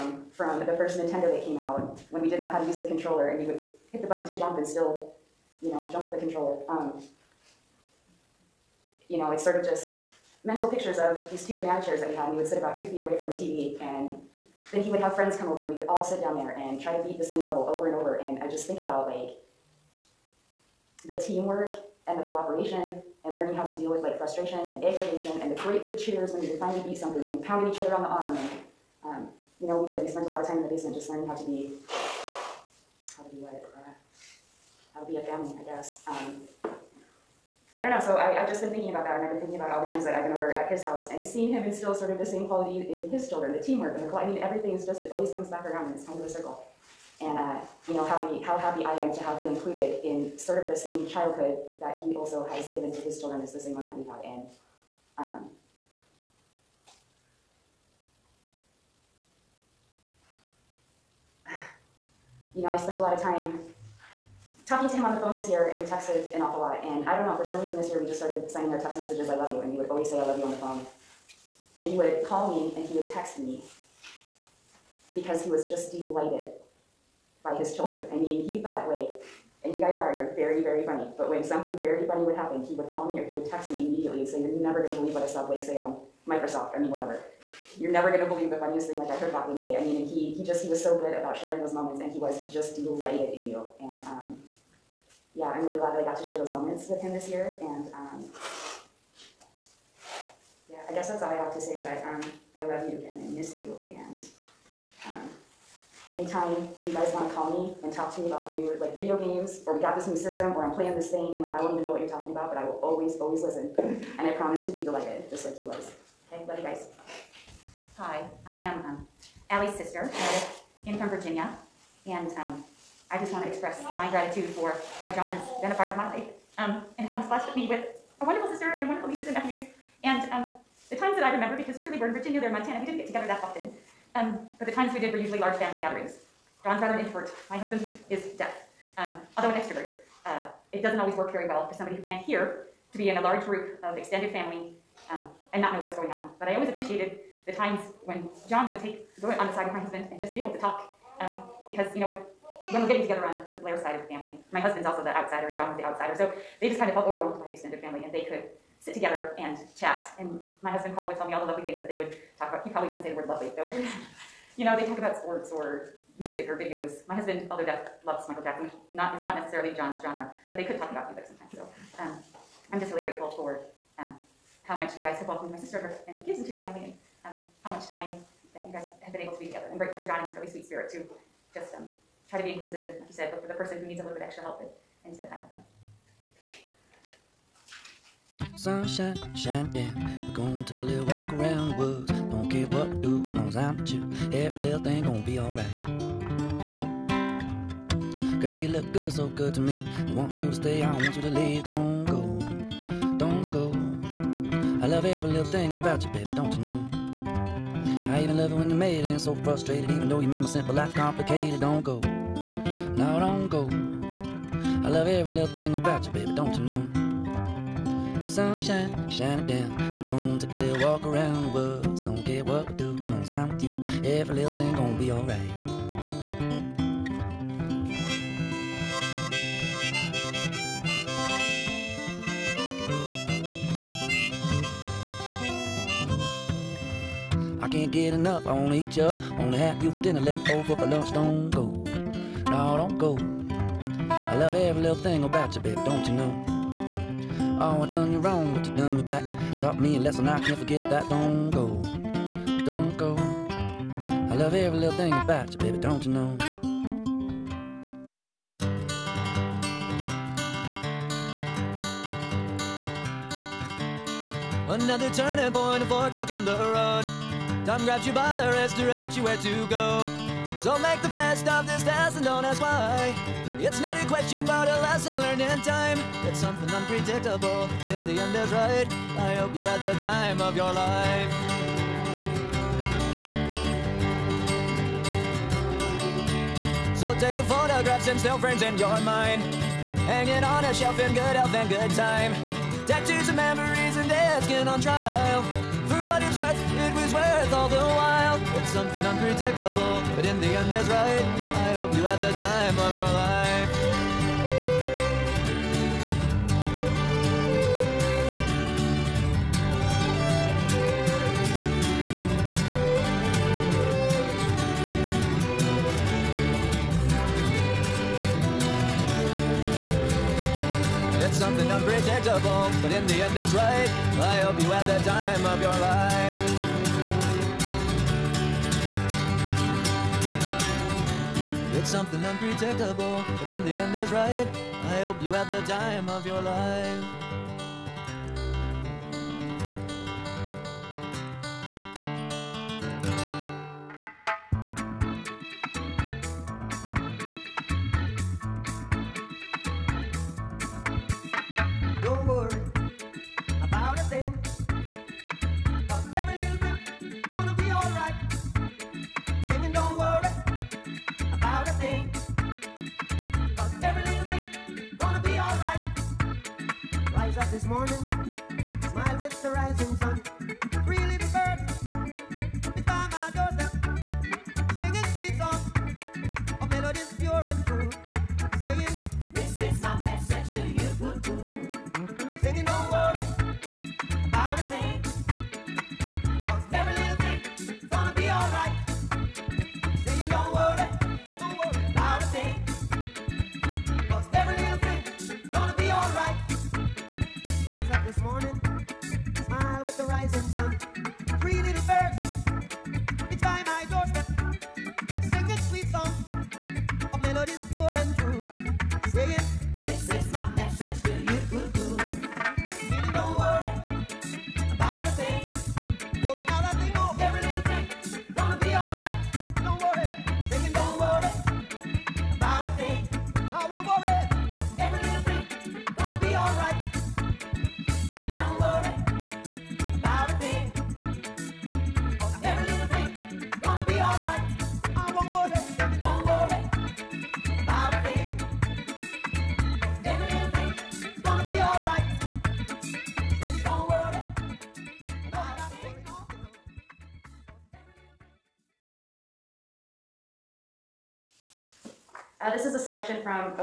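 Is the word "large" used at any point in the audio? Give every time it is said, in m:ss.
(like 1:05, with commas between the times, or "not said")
2:15, 2:23.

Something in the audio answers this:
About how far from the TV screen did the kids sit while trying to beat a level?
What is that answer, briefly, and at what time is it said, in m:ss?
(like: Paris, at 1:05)
2 feet, at 0:12.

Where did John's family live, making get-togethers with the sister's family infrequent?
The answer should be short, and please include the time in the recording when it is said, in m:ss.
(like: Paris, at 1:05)
Montana, at 2:12.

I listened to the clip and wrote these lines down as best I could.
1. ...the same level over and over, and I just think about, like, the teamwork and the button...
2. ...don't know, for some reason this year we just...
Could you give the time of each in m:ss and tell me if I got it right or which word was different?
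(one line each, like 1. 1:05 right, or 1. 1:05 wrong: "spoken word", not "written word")
1. 0:17 wrong: "cooperation", not "button"
2. 1:07 right.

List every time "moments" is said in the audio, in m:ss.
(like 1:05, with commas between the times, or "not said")
1:31, 1:36.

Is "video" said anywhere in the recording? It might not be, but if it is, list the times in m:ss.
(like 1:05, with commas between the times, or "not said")
1:48, 2:46.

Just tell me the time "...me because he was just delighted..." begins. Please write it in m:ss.
1:13.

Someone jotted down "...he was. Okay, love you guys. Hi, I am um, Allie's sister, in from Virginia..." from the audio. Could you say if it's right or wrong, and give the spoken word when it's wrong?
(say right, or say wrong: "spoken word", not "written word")
right.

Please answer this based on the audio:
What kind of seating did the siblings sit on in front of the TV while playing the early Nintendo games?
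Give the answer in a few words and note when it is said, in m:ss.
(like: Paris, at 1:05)
banana chairs, at 0:11.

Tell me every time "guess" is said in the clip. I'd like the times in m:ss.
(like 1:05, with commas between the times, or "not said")
0:35, 1:40.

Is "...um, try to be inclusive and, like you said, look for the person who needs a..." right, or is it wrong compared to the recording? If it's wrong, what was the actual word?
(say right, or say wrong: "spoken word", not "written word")
right.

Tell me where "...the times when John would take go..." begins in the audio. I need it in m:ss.
2:27.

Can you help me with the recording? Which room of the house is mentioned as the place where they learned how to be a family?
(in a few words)
basement.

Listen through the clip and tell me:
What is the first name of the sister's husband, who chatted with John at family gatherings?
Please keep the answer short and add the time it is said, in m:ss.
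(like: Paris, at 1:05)
Paul, at 2:40.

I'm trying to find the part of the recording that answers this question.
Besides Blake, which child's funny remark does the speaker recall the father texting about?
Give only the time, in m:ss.
1:29.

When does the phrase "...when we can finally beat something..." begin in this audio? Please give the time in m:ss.
0:26.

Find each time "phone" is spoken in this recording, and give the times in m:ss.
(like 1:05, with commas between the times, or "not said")
1:05, 1:10.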